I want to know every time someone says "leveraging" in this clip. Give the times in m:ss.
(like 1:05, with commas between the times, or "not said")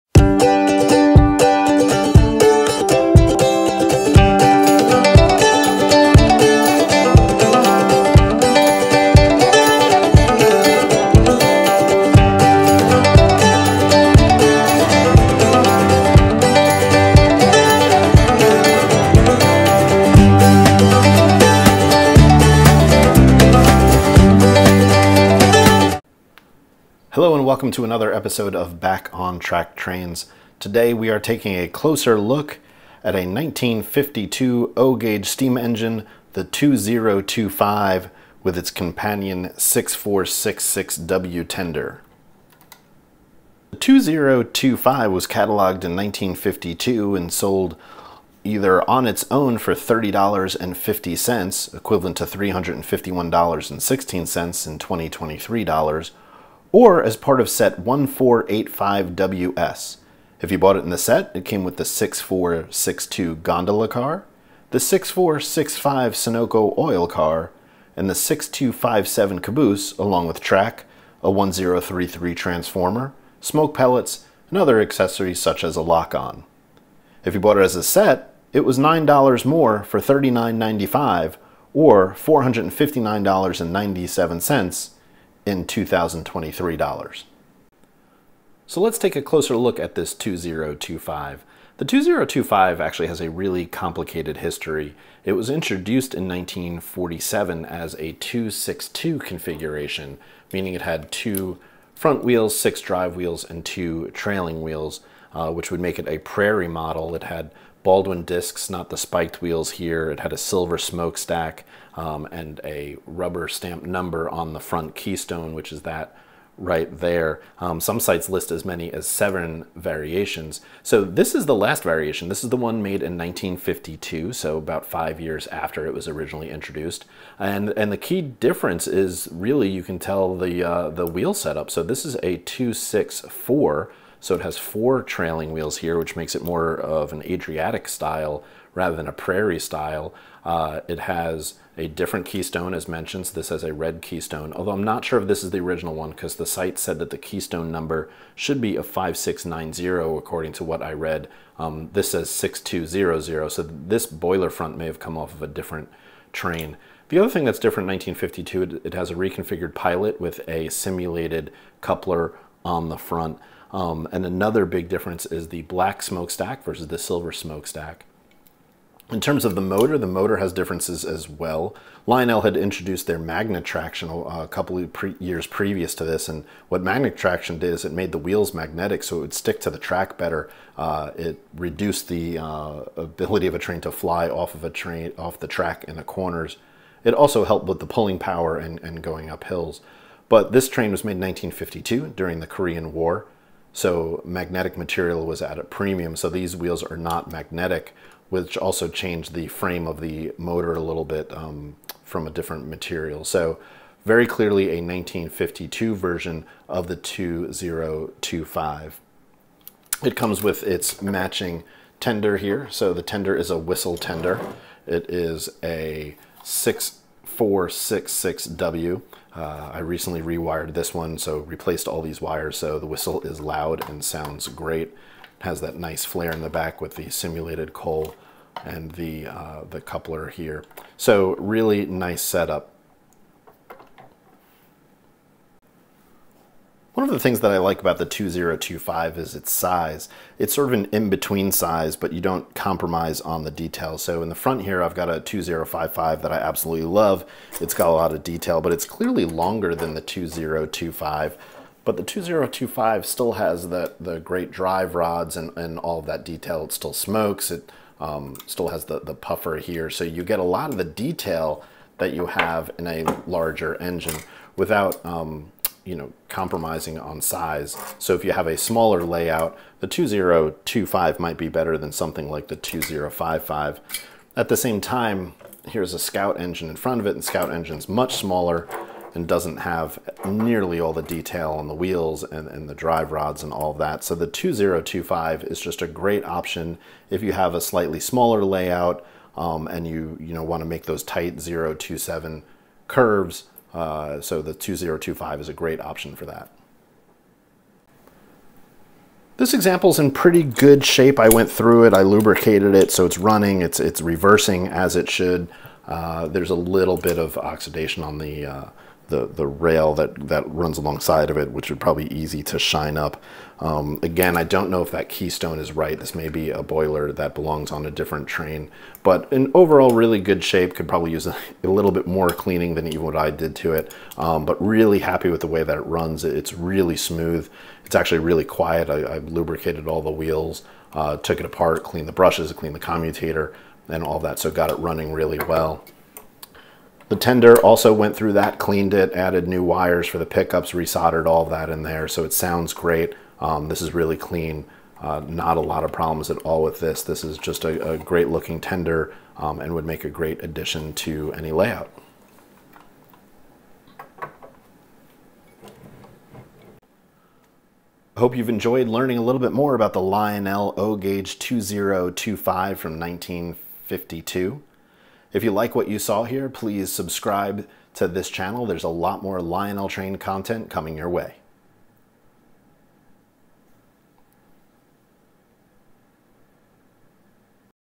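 not said.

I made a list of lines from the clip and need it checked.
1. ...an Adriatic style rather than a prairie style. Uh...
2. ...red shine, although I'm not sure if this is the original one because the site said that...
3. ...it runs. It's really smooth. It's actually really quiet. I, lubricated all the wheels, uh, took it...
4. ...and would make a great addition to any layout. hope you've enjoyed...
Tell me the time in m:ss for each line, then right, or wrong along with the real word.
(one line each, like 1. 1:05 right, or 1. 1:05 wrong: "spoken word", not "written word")
1. 2:17 right
2. 2:23 wrong: "keystone", not "shine"
3. 5:25 right
4. 5:49 right.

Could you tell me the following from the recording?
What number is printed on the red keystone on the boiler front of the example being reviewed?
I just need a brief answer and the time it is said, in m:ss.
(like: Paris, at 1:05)
6200, at 2:32.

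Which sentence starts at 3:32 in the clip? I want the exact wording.
So the tender is a whistle tender.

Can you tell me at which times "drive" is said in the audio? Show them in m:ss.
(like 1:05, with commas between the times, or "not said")
1:42, 4:14, 4:42.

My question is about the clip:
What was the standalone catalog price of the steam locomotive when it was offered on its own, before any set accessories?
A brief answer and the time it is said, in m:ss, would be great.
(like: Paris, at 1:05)
$30.50, at 0:49.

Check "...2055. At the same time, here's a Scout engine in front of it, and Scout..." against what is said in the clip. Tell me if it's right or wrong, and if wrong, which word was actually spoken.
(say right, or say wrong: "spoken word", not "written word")
right.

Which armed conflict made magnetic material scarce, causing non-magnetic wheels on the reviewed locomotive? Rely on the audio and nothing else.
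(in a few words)
Korean War.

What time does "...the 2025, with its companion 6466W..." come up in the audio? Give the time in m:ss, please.
0:36.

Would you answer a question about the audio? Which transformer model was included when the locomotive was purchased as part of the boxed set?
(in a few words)
1033.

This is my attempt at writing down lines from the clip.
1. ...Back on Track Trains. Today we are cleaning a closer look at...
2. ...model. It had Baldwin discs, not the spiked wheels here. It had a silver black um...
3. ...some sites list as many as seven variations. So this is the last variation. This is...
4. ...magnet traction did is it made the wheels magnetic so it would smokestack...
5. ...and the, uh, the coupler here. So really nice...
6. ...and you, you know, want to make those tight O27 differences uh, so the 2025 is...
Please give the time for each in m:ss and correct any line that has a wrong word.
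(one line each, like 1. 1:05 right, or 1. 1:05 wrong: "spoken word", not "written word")
1. 0:28 wrong: "taking", not "cleaning"
2. 1:46 wrong: "smokestack", not "black"
3. 1:57 right
4. 2:56 wrong: "stick", not "smokestack"
5. 3:48 right
6. 4:49 wrong: "curves", not "differences".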